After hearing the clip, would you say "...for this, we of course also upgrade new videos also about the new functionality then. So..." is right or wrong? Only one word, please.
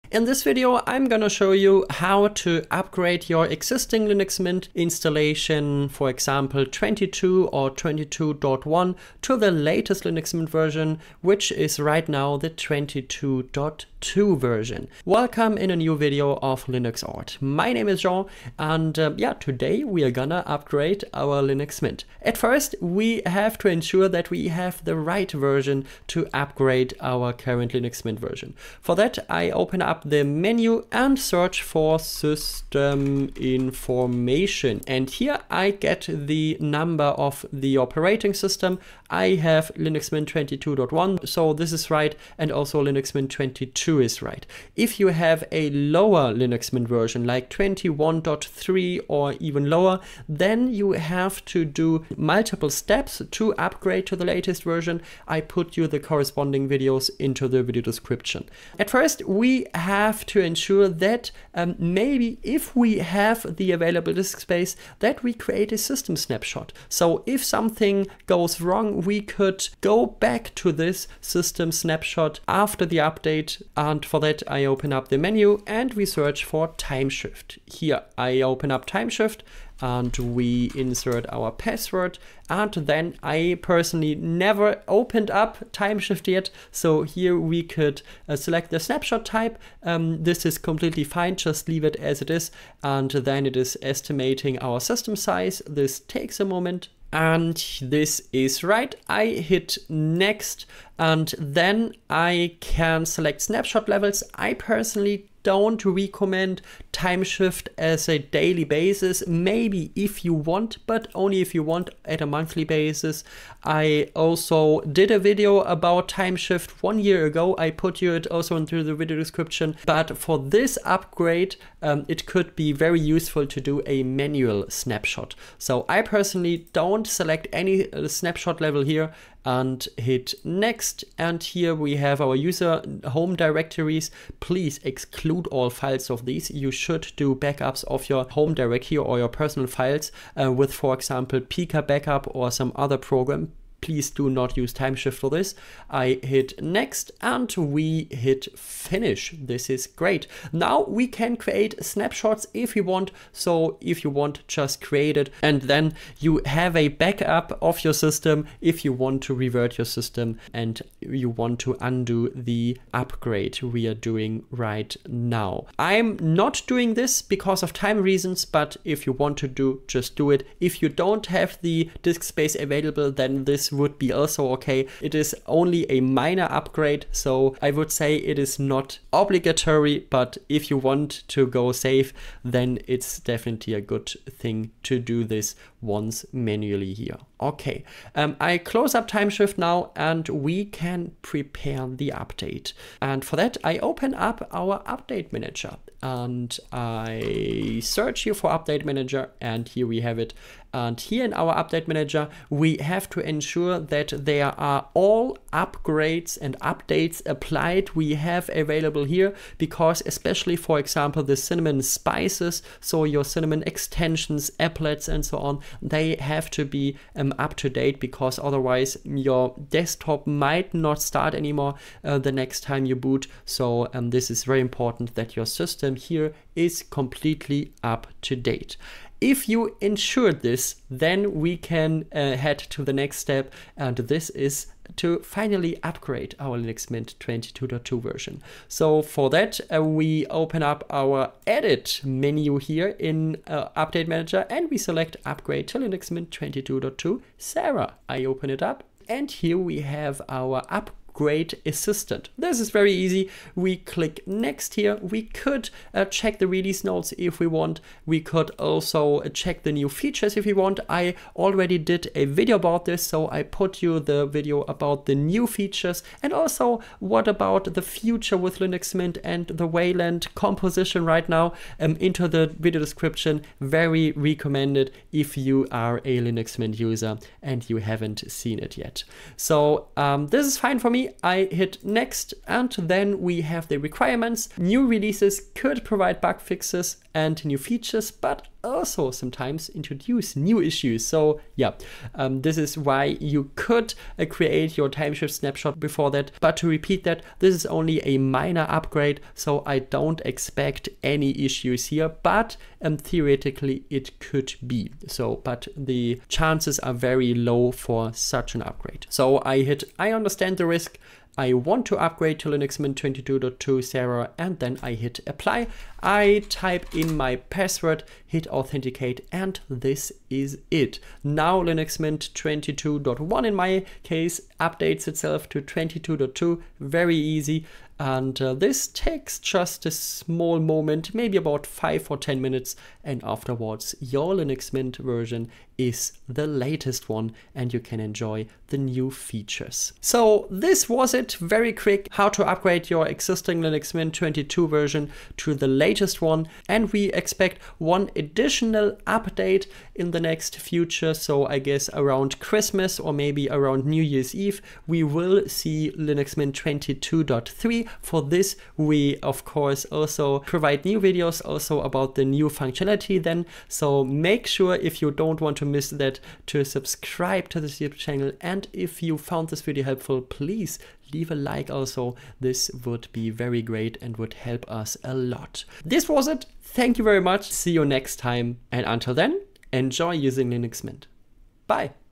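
wrong.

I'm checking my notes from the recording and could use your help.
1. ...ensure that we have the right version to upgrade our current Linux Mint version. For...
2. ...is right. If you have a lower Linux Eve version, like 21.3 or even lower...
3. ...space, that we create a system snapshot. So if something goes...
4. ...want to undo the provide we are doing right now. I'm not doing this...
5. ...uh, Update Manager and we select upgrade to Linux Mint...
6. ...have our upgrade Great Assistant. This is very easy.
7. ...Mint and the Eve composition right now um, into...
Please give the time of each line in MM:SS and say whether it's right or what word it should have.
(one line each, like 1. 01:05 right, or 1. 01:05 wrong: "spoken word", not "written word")
1. 00:23 right
2. 00:43 wrong: "Mint", not "Eve"
3. 01:04 right
4. 02:41 wrong: "upgrade", not "provide"
5. 04:03 right
6. 04:09 right
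7. 04:28 wrong: "Wayland", not "Eve".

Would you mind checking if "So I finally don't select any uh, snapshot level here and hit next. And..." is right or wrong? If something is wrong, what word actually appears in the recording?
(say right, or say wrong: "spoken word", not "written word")
wrong: "personally", not "finally".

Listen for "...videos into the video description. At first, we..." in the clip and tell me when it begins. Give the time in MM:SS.
00:56.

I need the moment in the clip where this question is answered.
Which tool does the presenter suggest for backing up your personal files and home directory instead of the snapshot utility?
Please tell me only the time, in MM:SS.
02:21.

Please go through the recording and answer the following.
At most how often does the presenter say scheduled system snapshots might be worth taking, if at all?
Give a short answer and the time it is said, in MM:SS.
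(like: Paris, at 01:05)
monthly, at 01:52.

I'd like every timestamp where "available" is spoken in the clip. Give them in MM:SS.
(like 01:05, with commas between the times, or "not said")
01:03, 02:52, 03:28.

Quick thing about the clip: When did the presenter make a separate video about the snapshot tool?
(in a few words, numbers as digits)
one year ago.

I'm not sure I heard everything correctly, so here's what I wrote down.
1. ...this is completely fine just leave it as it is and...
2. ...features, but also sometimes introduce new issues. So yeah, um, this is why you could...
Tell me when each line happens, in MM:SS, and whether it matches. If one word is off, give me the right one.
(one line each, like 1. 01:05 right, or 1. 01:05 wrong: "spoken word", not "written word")
1. 01:30 right
2. 04:47 right.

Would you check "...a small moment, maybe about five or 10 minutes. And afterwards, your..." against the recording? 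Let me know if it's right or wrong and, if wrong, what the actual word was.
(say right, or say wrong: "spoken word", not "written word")
right.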